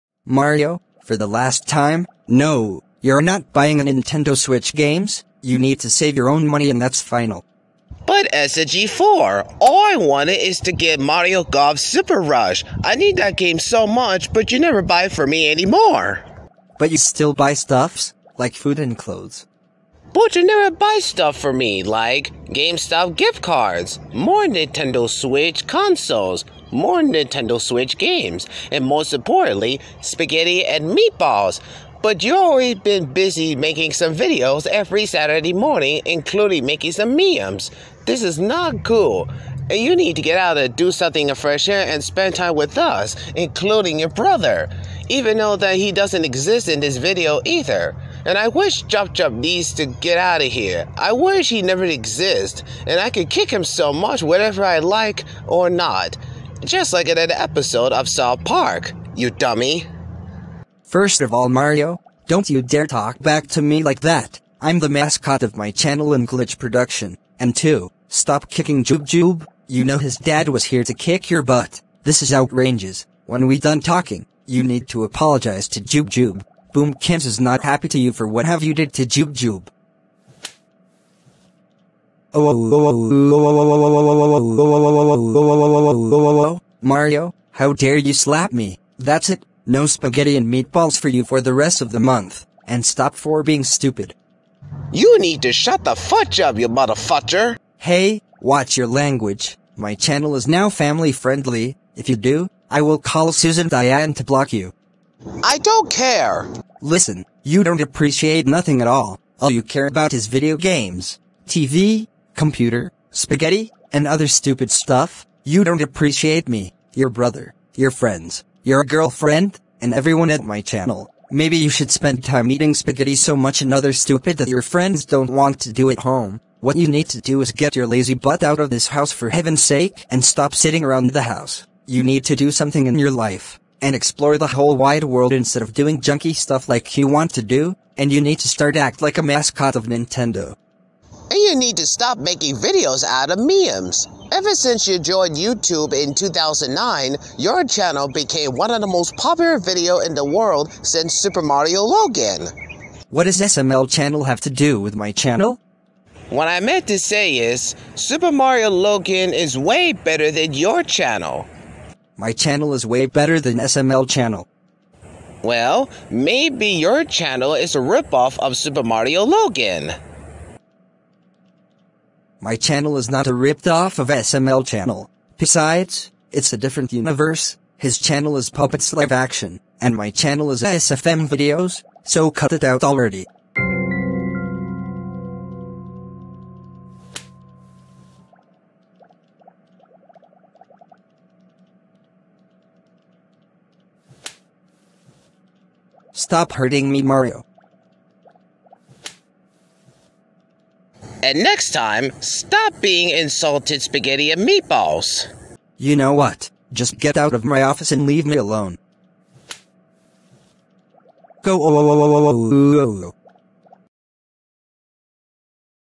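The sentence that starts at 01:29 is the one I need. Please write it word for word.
No spaghetti and meatballs for you for the rest of the month.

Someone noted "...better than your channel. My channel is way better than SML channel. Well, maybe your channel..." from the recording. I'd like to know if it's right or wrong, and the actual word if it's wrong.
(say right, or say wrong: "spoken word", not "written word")
right.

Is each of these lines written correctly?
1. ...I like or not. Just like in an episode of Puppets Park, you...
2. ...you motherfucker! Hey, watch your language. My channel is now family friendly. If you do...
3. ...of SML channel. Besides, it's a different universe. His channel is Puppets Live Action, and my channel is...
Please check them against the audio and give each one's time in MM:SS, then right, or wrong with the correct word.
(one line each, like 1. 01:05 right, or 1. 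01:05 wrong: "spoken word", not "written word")
1. 00:54 wrong: "South", not "Puppets"
2. 01:36 right
3. 02:53 right.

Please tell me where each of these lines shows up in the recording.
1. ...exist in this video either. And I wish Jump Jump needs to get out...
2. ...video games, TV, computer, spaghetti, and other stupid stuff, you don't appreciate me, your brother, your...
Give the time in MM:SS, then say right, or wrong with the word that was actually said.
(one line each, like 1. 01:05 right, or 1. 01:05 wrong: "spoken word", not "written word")
1. 00:46 right
2. 01:50 right.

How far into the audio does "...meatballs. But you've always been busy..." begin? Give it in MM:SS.
00:30.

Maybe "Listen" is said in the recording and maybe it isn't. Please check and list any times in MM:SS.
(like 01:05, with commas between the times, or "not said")
01:46.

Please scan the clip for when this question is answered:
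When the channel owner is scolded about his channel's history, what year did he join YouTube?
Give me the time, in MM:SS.
02:26.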